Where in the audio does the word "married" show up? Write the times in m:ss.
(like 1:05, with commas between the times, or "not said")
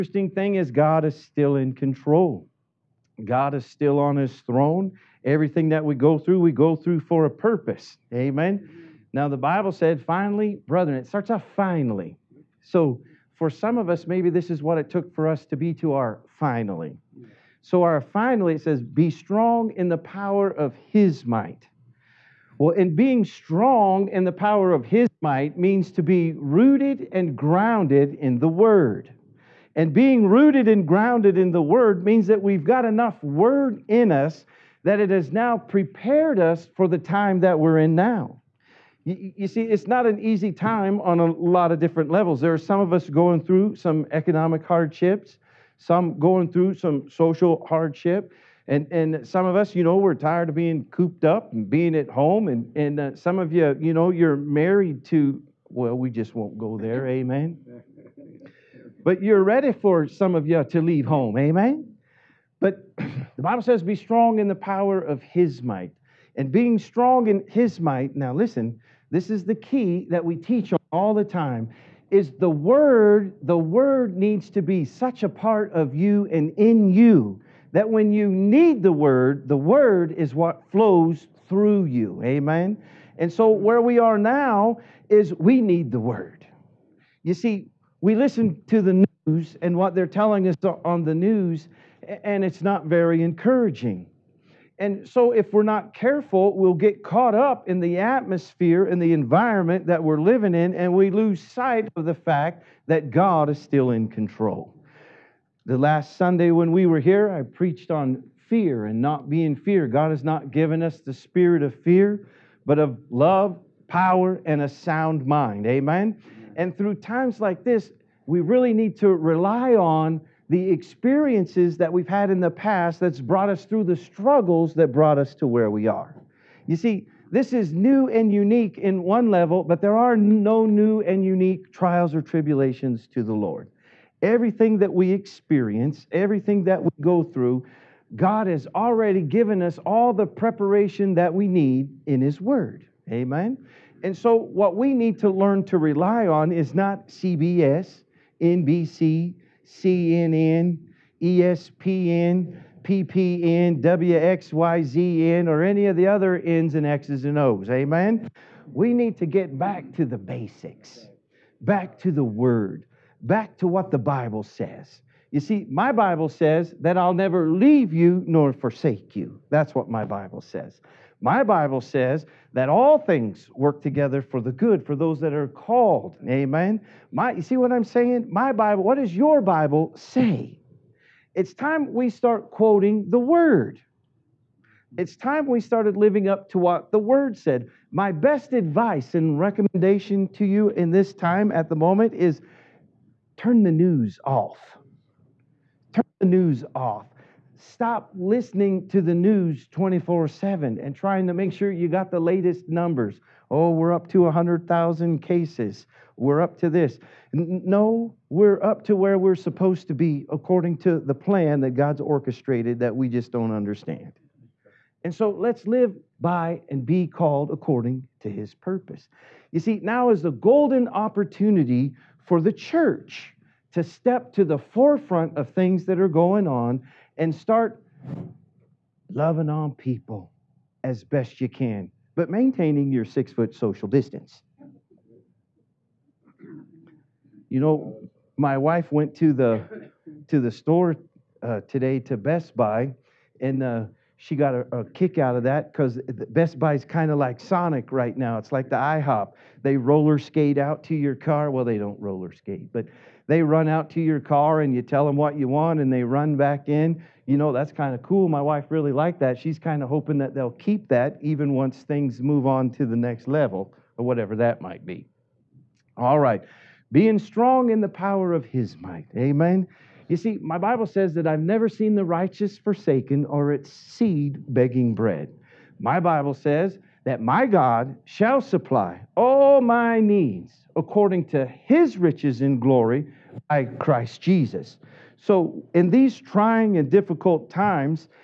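0:54.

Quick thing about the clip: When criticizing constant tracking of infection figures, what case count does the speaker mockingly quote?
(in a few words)
100,000.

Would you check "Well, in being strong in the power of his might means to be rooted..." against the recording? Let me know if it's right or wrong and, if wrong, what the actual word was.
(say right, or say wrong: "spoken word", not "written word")
right.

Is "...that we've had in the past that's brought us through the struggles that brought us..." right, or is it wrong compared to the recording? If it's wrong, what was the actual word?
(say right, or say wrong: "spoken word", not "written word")
right.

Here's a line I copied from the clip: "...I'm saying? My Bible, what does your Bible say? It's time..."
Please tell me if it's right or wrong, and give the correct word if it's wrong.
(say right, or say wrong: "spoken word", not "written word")
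right.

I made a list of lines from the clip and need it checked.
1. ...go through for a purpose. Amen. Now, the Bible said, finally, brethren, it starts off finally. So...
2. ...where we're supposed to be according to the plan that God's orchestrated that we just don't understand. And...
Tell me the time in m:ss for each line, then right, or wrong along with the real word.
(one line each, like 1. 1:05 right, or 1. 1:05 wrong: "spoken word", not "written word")
1. 0:06 right
2. 3:28 right.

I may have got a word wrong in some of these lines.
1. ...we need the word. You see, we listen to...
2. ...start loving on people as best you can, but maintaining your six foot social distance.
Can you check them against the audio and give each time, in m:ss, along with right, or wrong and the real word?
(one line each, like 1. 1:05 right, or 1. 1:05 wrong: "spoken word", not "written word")
1. 1:25 right
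2. 3:47 right.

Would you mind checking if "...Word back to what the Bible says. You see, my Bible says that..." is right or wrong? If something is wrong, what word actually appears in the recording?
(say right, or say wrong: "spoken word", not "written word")
right.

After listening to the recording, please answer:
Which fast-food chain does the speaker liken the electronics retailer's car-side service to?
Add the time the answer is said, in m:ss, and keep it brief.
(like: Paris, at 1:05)
Sonic, at 4:07.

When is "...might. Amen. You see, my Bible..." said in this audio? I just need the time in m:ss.
4:28.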